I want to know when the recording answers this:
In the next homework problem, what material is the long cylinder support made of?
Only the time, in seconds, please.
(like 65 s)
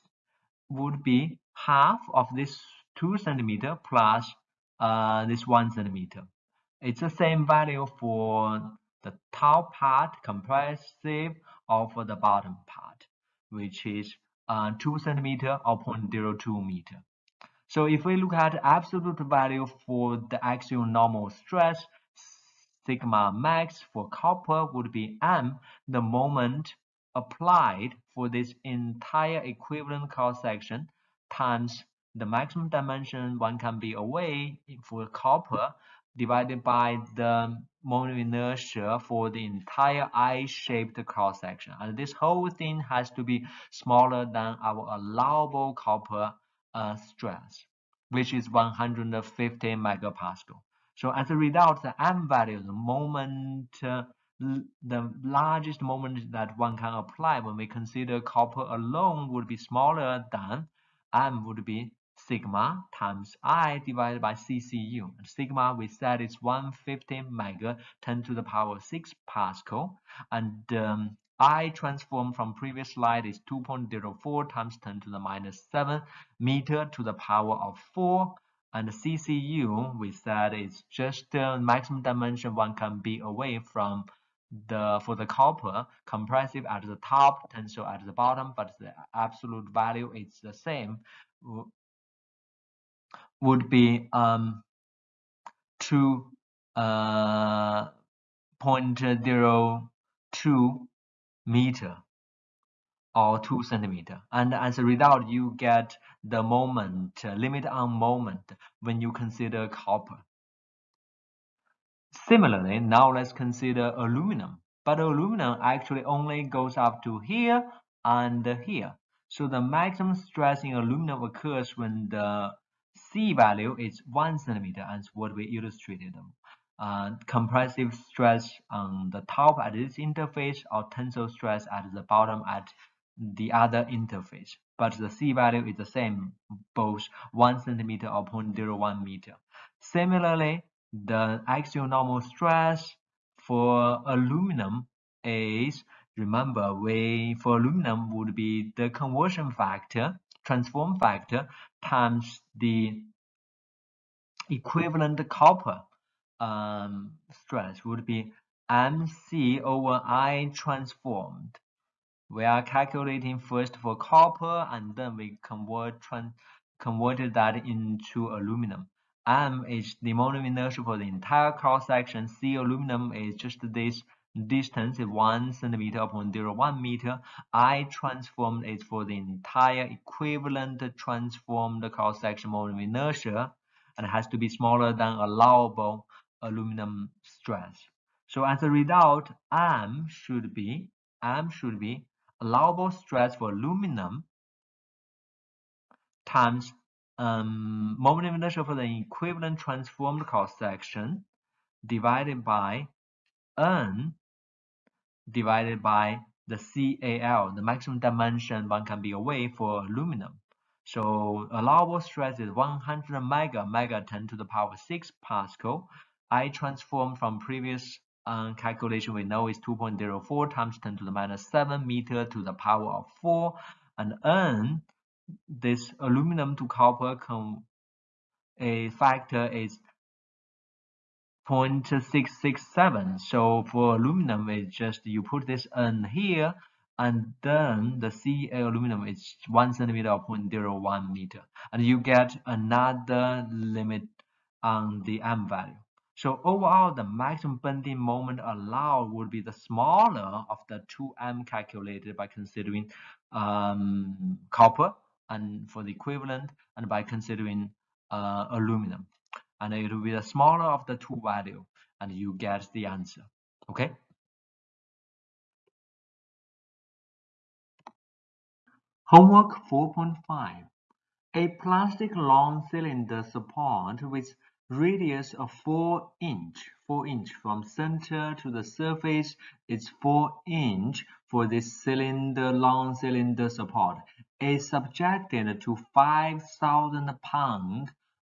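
271 s.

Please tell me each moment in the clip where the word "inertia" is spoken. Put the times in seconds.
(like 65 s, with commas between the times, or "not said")
38 s, 170 s, 182 s, 198 s.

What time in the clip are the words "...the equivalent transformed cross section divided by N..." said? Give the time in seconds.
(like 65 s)
198 s.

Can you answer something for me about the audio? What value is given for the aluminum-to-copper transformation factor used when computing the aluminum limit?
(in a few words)
0.667.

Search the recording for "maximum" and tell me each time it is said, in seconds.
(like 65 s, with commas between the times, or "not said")
32 s, 81 s, 119 s, 207 s, 247 s.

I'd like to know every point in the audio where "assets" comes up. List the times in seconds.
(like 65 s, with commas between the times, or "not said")
not said.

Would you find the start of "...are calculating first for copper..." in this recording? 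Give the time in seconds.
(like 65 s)
162 s.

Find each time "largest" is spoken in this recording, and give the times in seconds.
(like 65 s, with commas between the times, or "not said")
55 s.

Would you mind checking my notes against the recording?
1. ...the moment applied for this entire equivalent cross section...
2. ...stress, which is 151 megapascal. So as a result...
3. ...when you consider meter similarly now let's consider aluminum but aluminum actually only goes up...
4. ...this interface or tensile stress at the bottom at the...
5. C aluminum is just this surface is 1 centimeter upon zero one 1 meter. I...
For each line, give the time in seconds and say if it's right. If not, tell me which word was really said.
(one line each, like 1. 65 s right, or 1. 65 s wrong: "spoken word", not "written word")
1. 25 s right
2. 47 s wrong: "150", not "151"
3. 108 s wrong: "copper", not "meter"
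4. 129 s right
5. 172 s wrong: "distance", not "surface".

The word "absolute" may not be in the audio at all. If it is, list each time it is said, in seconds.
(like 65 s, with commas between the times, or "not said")
18 s, 89 s.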